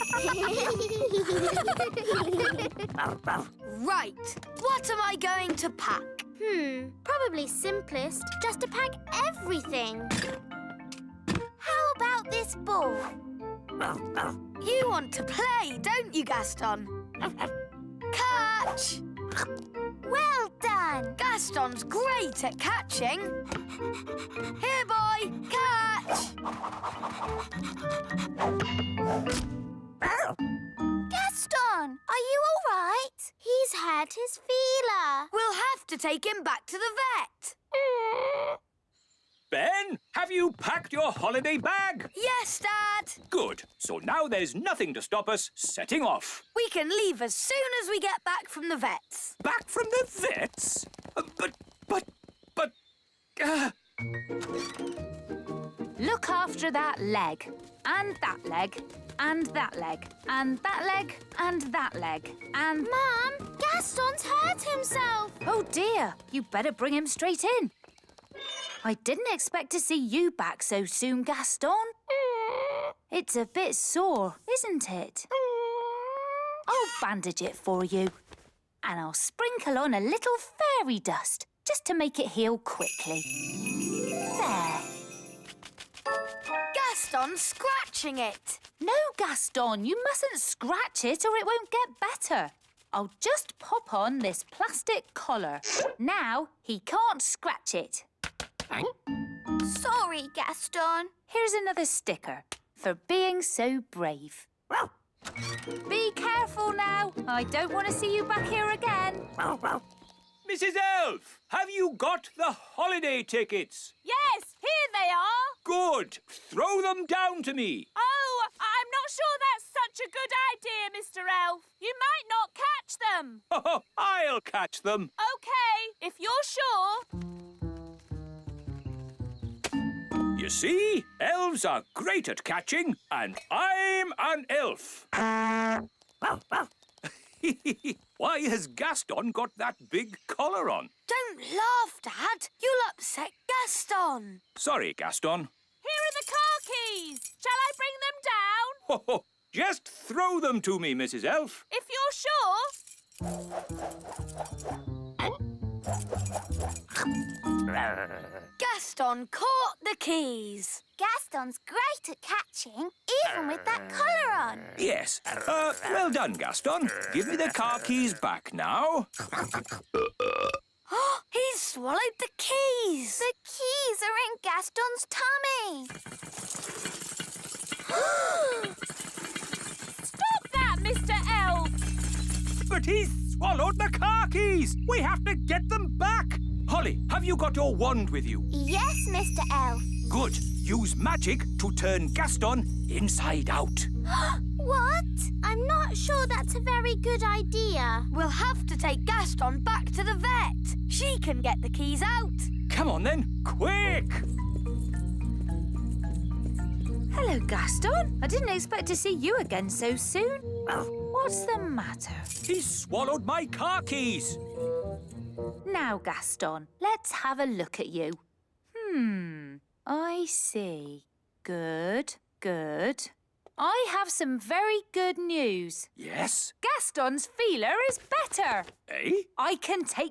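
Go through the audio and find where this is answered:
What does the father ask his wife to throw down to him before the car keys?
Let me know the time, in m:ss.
1:52.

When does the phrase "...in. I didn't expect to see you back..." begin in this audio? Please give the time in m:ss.
1:07.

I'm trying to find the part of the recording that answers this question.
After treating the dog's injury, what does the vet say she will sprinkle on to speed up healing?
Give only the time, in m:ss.
1:20.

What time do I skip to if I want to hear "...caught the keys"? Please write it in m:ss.
2:39.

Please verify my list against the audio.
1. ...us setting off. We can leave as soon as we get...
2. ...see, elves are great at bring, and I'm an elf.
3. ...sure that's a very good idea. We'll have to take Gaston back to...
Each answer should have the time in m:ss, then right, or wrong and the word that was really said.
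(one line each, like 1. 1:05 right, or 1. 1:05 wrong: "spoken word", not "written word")
1. 0:45 right
2. 2:10 wrong: "catching", not "bring"
3. 3:15 right.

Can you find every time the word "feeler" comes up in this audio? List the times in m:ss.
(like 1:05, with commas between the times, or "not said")
0:34, 3:47.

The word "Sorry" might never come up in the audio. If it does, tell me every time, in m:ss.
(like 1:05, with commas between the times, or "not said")
1:39, 2:24.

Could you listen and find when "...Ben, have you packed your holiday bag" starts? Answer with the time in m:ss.
0:39.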